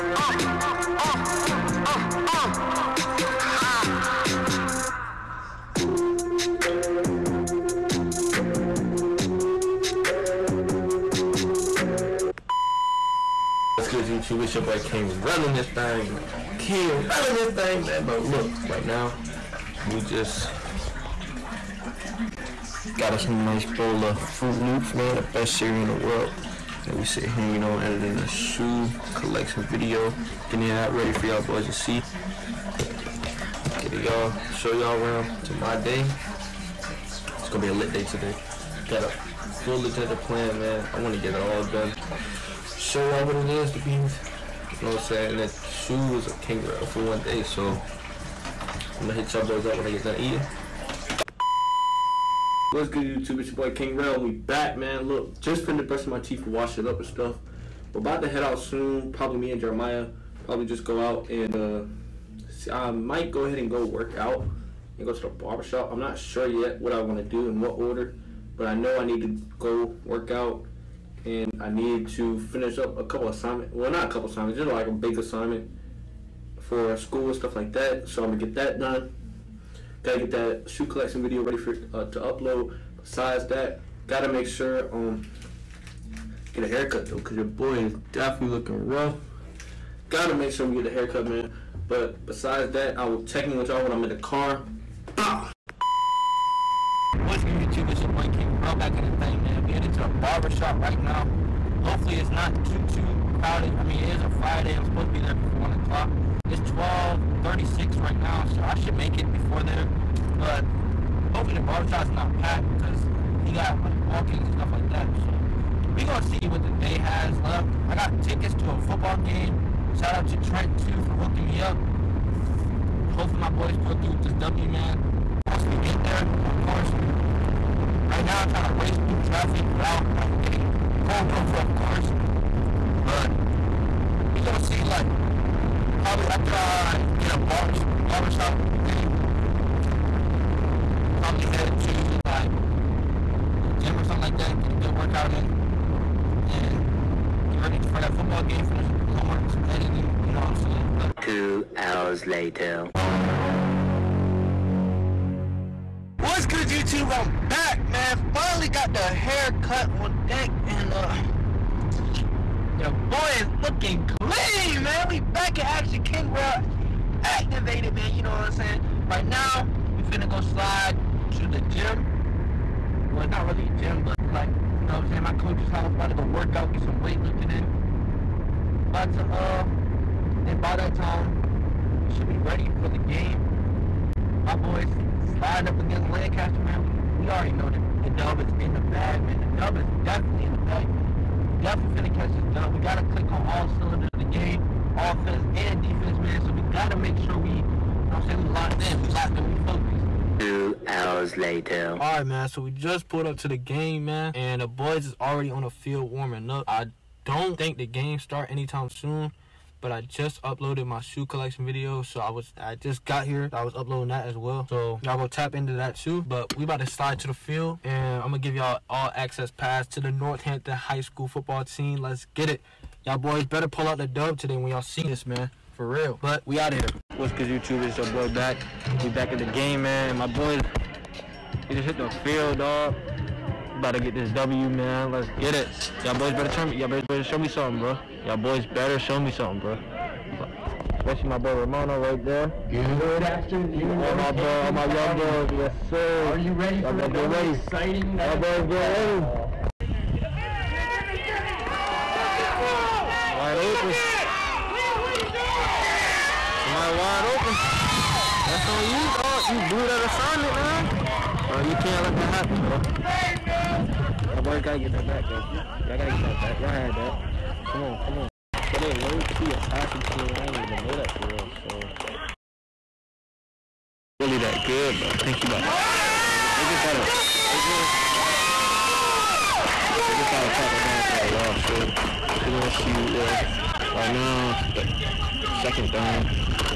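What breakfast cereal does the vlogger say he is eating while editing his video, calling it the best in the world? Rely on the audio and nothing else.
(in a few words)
Froot Loops.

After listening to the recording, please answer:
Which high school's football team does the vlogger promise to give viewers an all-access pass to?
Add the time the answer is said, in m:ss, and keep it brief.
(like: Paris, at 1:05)
Northampton High School, at 3:40.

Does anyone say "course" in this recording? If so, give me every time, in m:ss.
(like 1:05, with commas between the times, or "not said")
2:06, 2:11.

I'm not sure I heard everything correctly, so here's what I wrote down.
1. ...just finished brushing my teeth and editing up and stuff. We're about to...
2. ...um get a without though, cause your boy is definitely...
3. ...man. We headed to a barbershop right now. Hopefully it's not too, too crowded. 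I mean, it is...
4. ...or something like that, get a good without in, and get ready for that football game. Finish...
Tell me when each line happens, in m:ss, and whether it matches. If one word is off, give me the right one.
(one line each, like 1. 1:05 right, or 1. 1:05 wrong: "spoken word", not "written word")
1. 0:55 wrong: "washing", not "editing"
2. 1:24 wrong: "haircut", not "without"
3. 1:39 right
4. 2:23 wrong: "workout", not "without".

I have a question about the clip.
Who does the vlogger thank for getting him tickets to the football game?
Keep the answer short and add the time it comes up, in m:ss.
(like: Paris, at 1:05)
Trent, at 2:00.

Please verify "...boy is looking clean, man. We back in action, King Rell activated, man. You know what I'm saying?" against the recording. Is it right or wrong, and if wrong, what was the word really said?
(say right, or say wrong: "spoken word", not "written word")
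right.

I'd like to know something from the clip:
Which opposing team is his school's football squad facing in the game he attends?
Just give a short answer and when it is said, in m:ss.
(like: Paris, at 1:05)
Lancaster, at 3:06.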